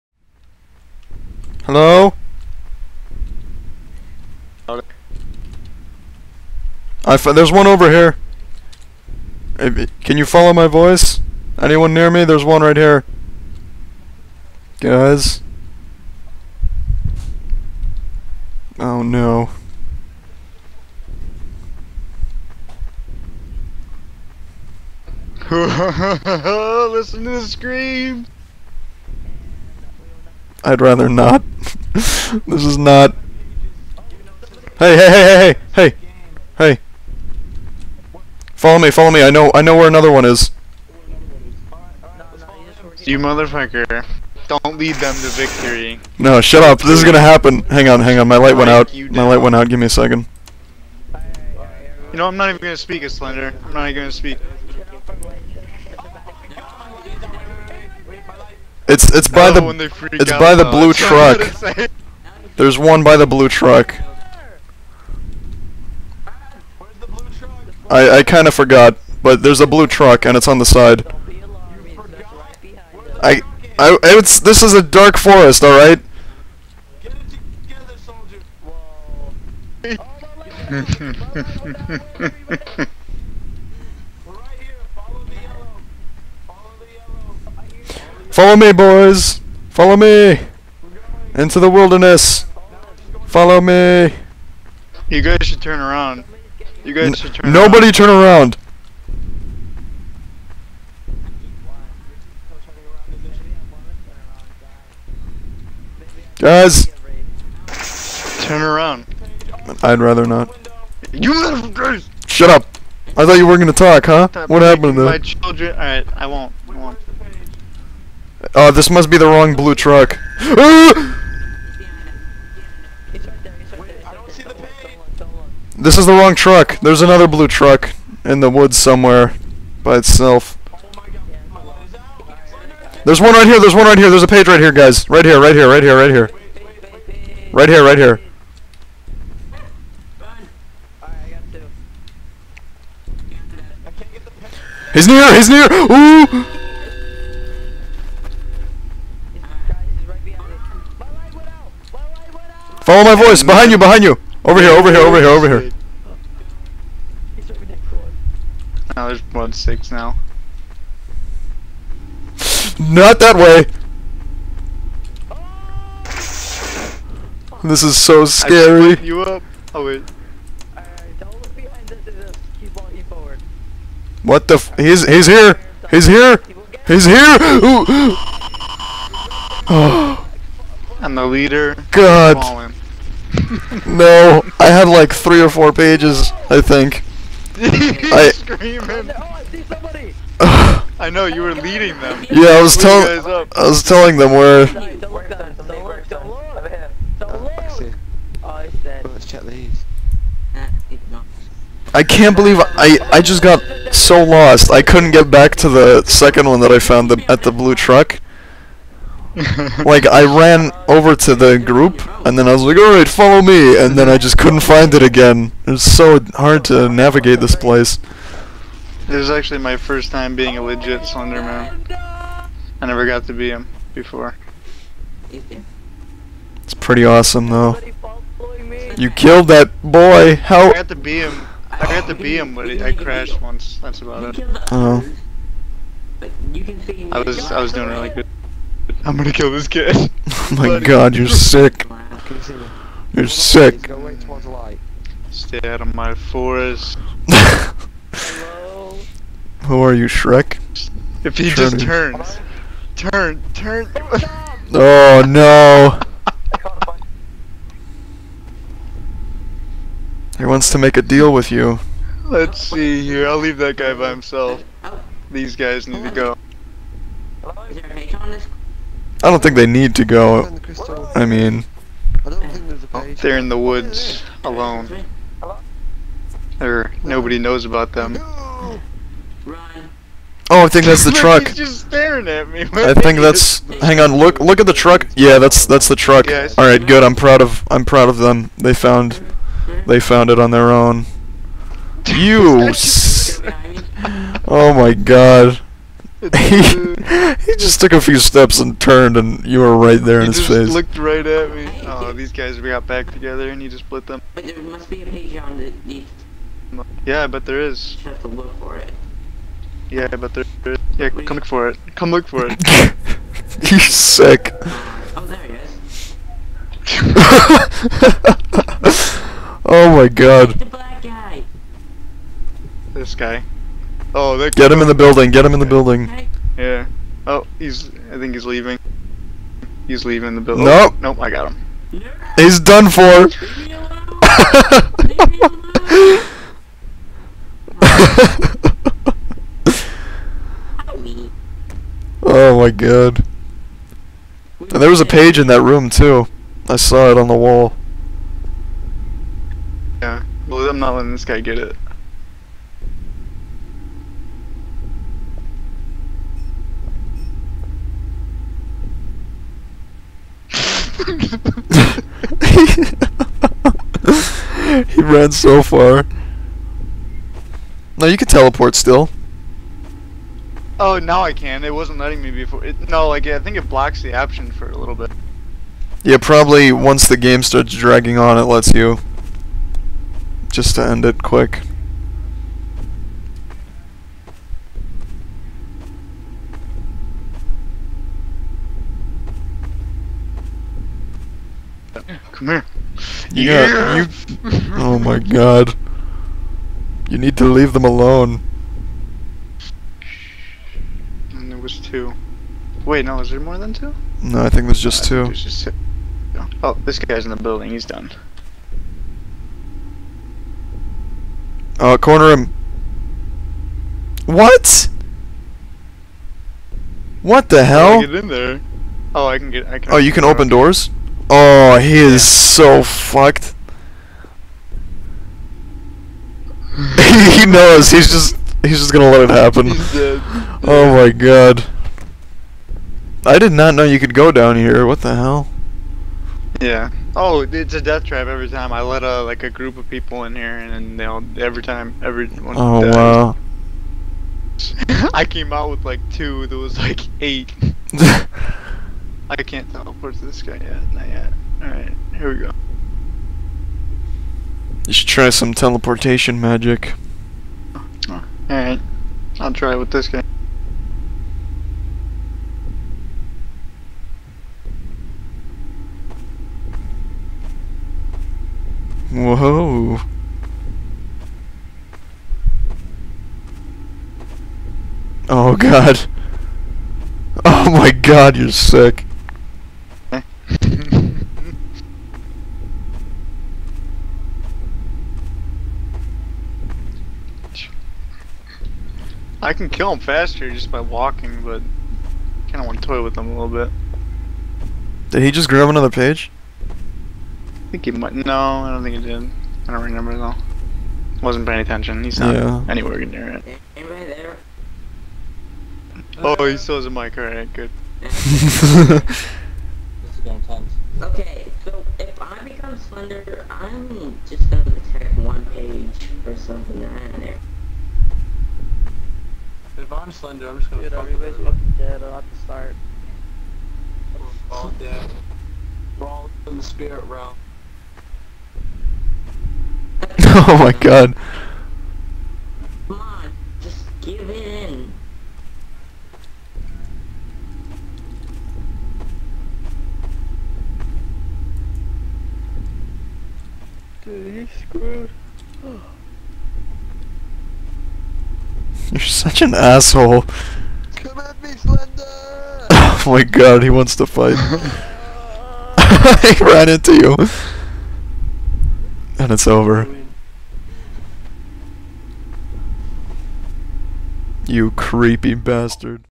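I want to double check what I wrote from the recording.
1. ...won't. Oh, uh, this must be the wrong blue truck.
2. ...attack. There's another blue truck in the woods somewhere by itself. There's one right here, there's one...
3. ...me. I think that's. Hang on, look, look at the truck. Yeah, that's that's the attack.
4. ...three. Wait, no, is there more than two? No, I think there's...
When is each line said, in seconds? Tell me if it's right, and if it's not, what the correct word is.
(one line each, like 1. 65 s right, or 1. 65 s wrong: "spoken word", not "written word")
1. 116 s right
2. 126 s wrong: "truck", not "attack"
3. 282 s wrong: "truck", not "attack"
4. 401 s wrong: "two", not "three".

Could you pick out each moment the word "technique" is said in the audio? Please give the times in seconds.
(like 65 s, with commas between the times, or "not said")
not said.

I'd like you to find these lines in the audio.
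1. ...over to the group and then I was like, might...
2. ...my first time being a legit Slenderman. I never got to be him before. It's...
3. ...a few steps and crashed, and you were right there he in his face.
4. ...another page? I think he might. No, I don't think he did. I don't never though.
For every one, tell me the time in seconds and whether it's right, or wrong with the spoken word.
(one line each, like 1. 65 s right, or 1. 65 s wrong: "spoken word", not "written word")
1. 210 s wrong: "alright", not "might"
2. 219 s right
3. 297 s wrong: "turned", not "crashed"
4. 495 s wrong: "remember", not "never".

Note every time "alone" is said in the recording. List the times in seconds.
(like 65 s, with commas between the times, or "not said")
274 s, 397 s.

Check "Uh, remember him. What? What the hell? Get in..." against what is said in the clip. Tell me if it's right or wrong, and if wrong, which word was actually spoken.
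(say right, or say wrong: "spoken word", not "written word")
wrong: "corner", not "remember".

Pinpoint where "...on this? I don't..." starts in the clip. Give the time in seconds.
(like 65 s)
268 s.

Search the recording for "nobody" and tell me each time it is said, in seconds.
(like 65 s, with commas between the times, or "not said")
97 s, 277 s.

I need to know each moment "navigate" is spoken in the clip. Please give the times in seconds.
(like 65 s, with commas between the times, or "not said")
216 s.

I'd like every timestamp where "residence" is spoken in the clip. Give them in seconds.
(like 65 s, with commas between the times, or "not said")
not said.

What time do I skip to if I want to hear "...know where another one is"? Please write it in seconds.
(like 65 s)
39 s.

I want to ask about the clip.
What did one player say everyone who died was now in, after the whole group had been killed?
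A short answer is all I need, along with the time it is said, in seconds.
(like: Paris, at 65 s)
The spirit realm, at 526 s.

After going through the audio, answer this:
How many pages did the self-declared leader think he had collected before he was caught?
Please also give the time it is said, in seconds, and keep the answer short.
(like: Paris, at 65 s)
3 or 4, at 185 s.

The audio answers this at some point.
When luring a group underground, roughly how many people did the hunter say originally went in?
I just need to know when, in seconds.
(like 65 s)
447 s.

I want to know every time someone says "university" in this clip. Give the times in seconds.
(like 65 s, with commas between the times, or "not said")
not said.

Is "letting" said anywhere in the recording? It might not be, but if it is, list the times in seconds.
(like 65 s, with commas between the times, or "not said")
350 s, 371 s.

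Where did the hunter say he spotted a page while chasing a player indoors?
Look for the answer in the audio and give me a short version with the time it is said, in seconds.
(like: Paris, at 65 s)
On the wall, at 346 s.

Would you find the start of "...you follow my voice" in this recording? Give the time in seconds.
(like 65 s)
10 s.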